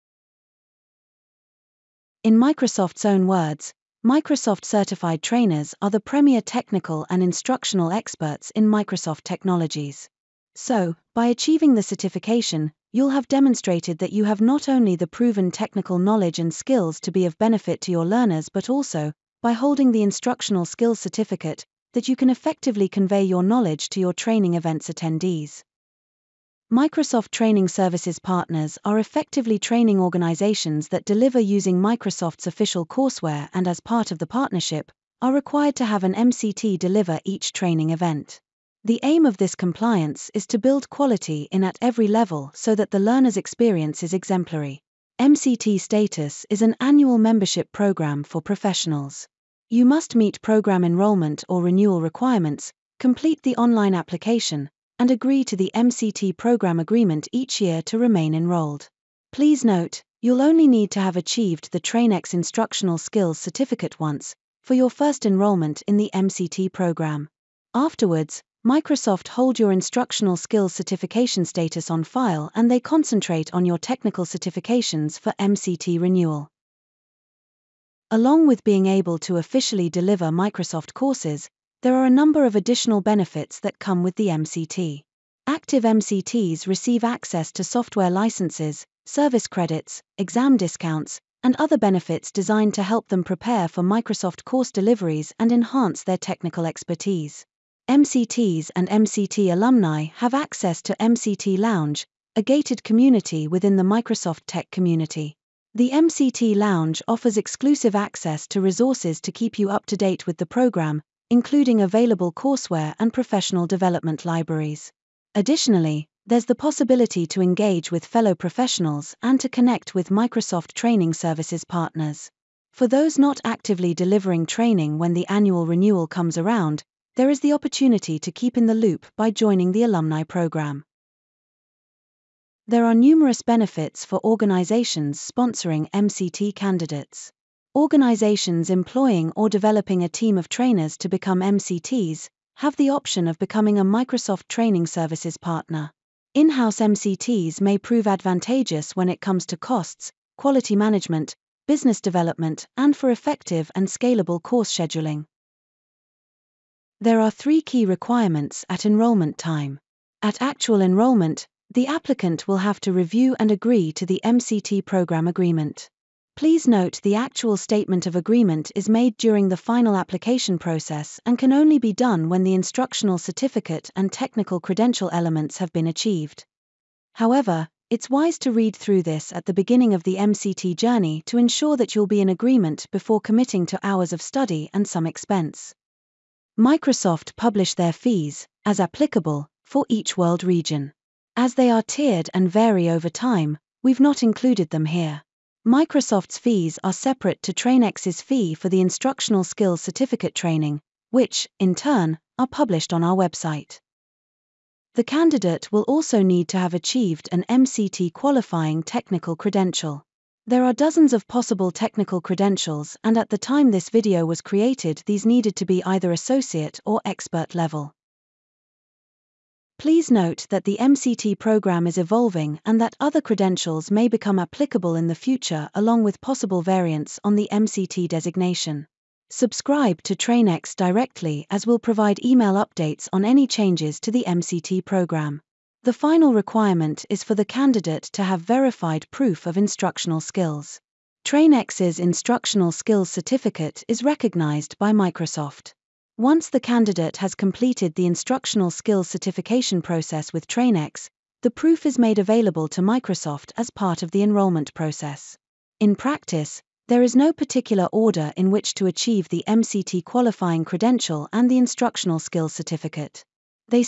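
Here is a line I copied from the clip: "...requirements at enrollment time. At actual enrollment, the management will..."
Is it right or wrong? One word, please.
wrong.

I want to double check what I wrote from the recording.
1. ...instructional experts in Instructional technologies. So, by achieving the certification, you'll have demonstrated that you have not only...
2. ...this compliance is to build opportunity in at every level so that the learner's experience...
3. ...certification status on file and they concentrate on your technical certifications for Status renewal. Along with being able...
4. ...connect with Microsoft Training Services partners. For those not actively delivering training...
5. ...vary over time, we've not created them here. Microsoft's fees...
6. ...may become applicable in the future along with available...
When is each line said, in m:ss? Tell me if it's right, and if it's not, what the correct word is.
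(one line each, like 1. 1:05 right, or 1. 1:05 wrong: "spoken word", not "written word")
1. 0:07 wrong: "Microsoft", not "Instructional"
2. 0:39 wrong: "quality", not "opportunity"
3. 1:10 wrong: "MCT", not "Status"
4. 1:59 right
5. 3:12 wrong: "included", not "created"
6. 3:43 wrong: "possible", not "available".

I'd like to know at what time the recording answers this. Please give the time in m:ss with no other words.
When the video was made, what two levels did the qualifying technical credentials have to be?
3:36.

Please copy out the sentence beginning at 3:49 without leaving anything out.
Subscribe to TrainX directly as we'll provide email updates on any changes to the MCT program.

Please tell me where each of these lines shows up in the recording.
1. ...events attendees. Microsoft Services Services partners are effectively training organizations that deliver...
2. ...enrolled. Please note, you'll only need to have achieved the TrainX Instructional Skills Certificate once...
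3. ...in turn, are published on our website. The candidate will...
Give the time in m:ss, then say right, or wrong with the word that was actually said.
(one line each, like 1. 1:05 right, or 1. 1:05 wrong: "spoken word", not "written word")
1. 0:24 wrong: "Training", not "Services"
2. 0:58 right
3. 3:21 right.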